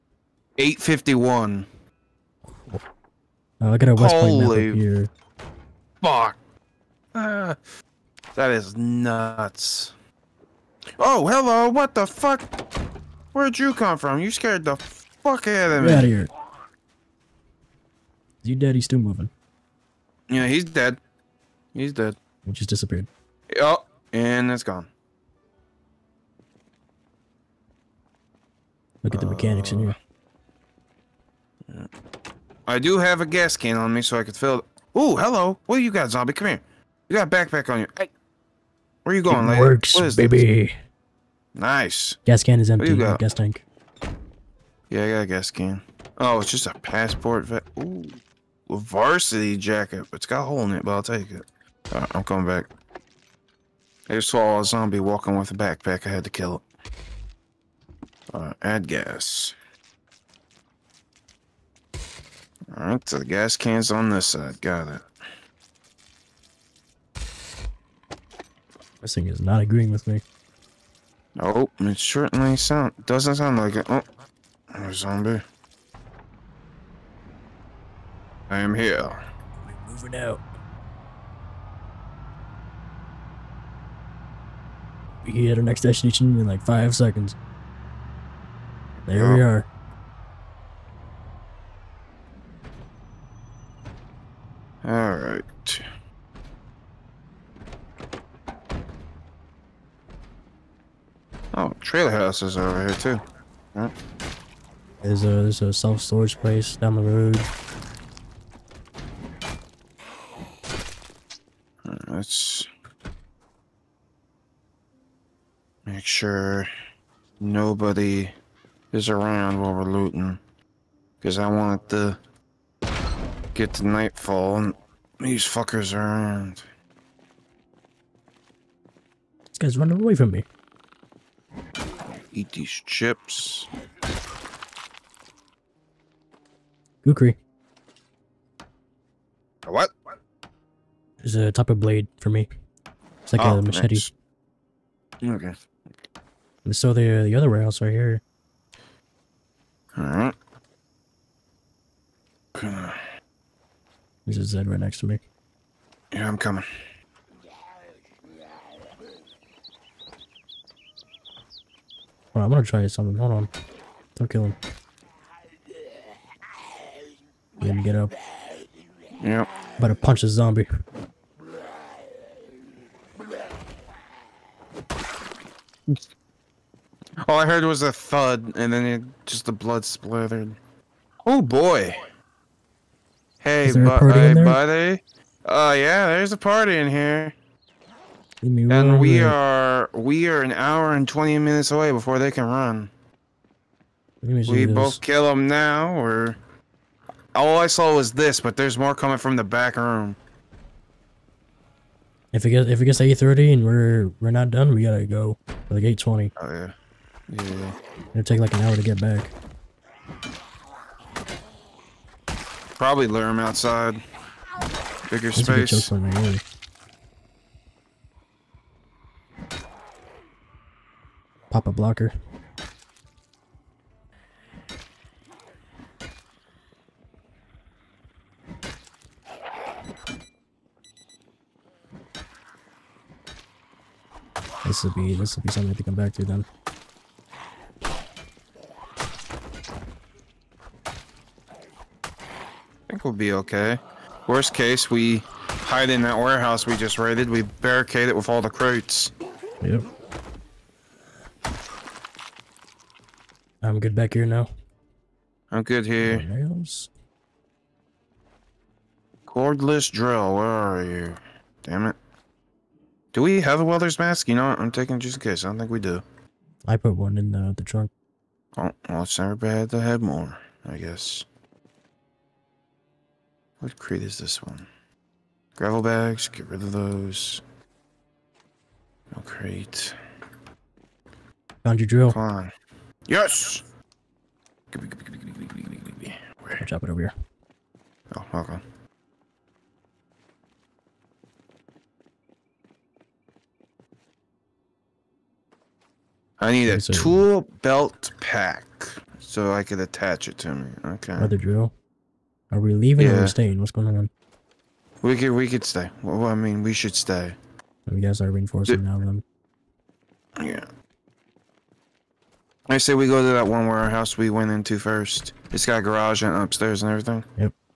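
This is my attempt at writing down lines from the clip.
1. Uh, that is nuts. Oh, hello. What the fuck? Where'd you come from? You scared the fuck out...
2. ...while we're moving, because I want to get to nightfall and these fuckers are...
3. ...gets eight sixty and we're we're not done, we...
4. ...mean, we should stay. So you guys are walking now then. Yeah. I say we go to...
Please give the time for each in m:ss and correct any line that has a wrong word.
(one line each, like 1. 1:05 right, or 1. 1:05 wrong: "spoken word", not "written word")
1. 0:07 right
2. 1:59 wrong: "looting", not "moving"
3. 3:22 wrong: "thirty", not "sixty"
4. 5:06 wrong: "reinforcing", not "walking".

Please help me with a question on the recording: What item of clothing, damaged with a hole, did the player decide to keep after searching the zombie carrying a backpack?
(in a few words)
Varsity jacket.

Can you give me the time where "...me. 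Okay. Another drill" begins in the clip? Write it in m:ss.
5:00.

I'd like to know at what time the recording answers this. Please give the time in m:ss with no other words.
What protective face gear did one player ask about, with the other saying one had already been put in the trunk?
4:23.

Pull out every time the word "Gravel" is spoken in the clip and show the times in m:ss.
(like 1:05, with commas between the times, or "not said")
4:35.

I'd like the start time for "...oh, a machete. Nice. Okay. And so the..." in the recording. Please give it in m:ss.
2:23.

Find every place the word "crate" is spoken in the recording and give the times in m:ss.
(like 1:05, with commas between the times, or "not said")
4:08, 4:33, 4:39.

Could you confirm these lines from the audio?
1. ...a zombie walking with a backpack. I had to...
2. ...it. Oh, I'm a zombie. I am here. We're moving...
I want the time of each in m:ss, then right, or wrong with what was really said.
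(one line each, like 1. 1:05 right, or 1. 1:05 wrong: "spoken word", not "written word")
1. 0:54 right
2. 1:13 right.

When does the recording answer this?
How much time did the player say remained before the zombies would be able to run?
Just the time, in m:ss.
3:10.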